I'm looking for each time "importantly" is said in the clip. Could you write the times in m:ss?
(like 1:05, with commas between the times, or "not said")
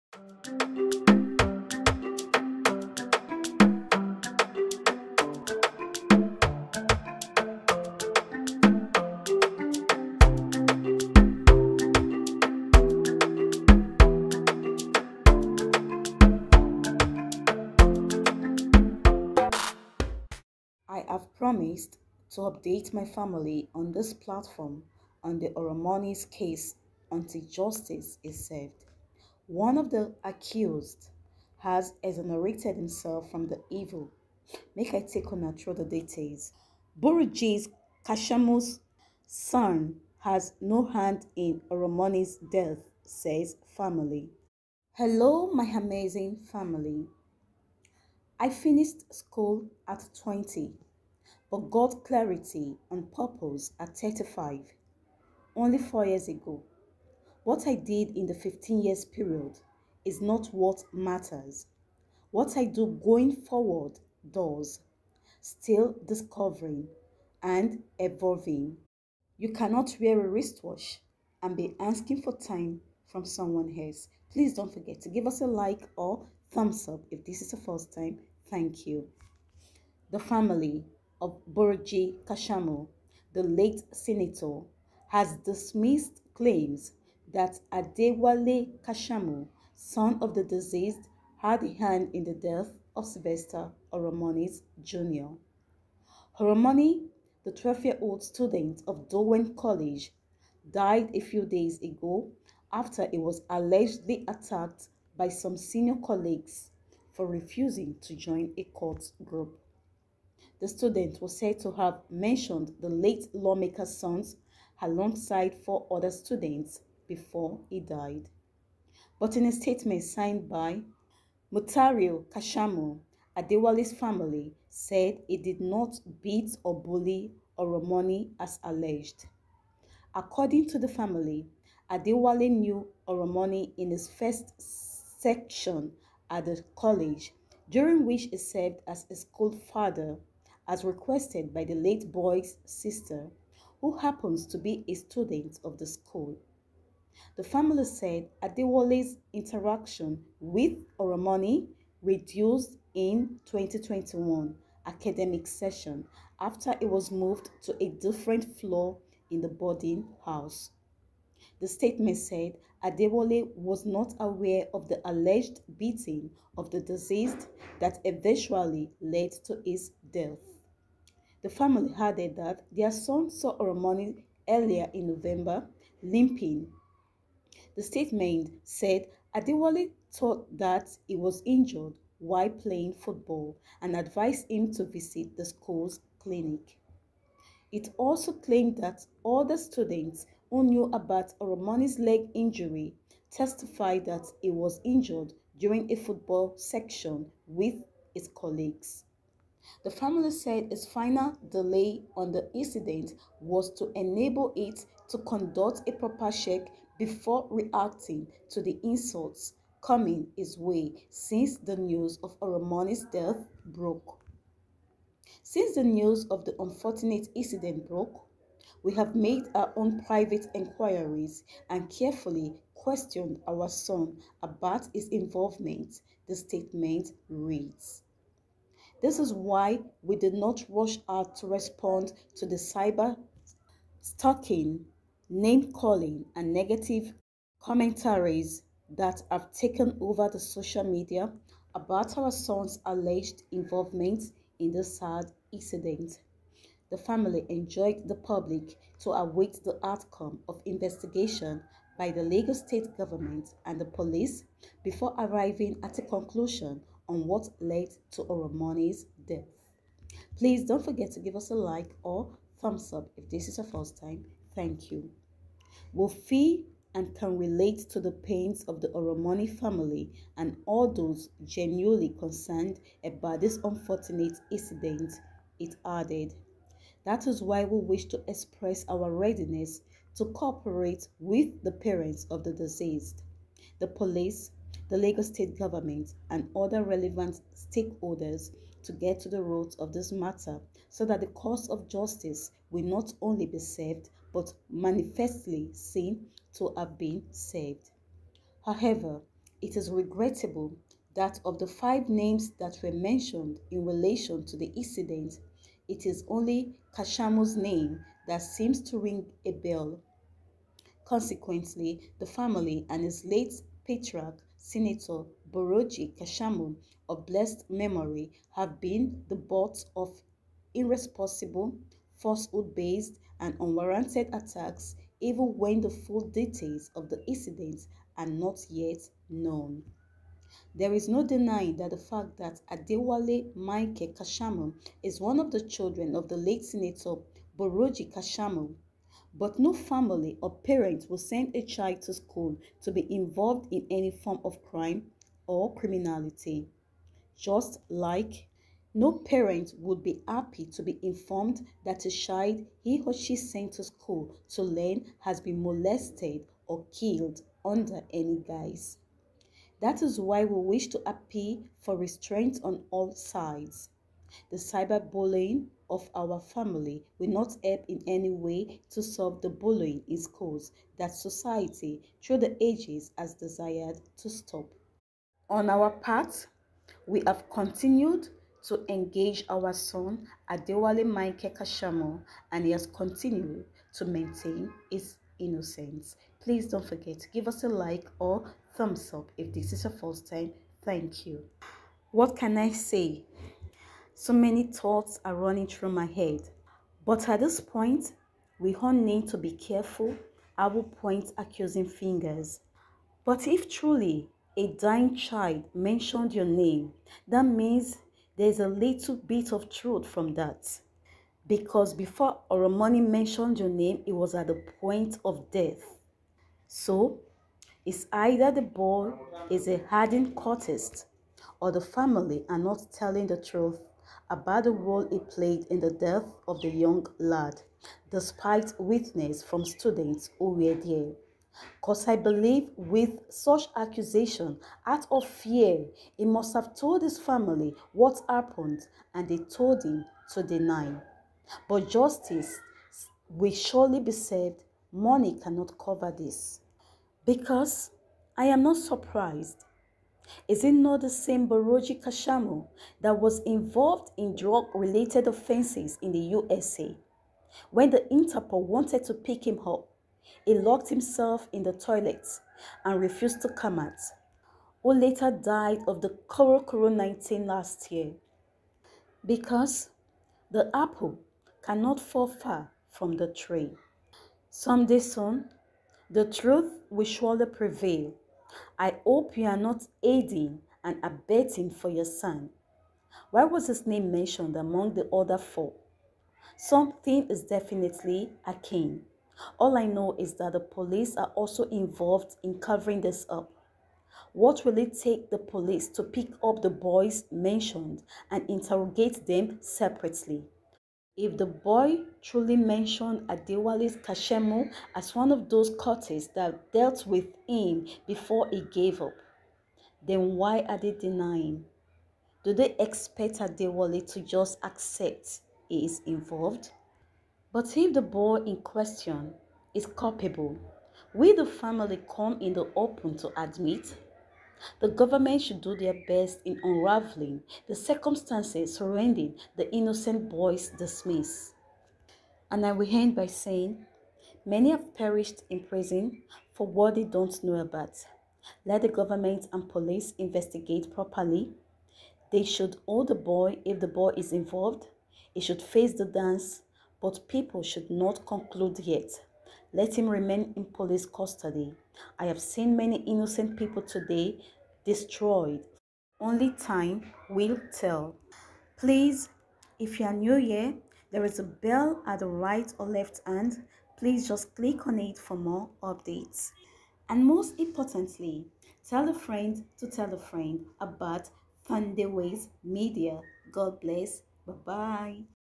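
9:27.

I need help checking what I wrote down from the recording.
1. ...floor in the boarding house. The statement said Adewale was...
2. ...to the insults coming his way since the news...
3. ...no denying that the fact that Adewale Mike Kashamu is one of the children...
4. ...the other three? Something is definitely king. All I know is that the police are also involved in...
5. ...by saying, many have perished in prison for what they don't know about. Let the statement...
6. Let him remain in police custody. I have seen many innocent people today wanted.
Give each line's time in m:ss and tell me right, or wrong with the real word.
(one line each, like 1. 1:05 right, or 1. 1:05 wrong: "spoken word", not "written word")
1. 2:38 right
2. 3:28 right
3. 5:31 right
4. 8:04 wrong: "four", not "three"
5. 8:53 wrong: "government", not "statement"
6. 9:09 wrong: "destroyed", not "wanted".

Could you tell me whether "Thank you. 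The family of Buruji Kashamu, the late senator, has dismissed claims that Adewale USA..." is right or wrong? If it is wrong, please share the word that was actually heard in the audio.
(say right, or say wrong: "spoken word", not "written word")
wrong: "Kashamu", not "USA".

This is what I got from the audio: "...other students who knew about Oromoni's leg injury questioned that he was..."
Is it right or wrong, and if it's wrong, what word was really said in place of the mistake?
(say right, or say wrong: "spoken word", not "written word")
wrong: "testified", not "questioned".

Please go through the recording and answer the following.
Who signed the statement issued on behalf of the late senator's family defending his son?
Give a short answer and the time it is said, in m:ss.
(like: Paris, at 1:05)
Mutario Kashamu, at 2:01.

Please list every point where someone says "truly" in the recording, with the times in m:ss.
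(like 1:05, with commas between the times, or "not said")
6:43, 8:22.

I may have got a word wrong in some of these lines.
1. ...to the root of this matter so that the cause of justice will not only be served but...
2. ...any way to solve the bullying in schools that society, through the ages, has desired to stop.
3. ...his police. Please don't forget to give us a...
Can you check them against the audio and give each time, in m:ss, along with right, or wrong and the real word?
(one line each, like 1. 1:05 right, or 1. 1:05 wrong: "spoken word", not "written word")
1. 4:49 right
2. 6:08 right
3. 6:24 wrong: "innocence", not "police".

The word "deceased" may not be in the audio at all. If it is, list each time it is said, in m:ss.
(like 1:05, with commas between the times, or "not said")
1:30, 2:46, 4:42.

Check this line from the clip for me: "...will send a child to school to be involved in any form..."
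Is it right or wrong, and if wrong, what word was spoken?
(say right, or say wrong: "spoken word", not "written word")
right.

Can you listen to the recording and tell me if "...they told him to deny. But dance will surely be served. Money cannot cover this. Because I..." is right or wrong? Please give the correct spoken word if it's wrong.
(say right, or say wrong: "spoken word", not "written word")
wrong: "justice", not "dance".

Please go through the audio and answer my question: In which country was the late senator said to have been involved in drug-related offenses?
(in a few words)
USA.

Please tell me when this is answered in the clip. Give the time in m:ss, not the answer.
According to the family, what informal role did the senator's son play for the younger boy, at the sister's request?
2:19.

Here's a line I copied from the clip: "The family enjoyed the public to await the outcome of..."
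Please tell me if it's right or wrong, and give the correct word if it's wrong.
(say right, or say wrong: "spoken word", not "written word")
right.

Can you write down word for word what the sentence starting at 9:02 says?
They should hold the boy if the boy is involved.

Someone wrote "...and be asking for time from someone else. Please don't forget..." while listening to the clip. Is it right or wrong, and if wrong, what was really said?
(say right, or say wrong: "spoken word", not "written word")
right.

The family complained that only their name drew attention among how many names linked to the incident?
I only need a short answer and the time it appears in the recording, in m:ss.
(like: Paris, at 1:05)
5, at 5:01.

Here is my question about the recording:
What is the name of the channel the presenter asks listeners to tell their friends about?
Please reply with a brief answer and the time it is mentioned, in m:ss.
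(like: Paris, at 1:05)
Thandiwe's Media, at 9:31.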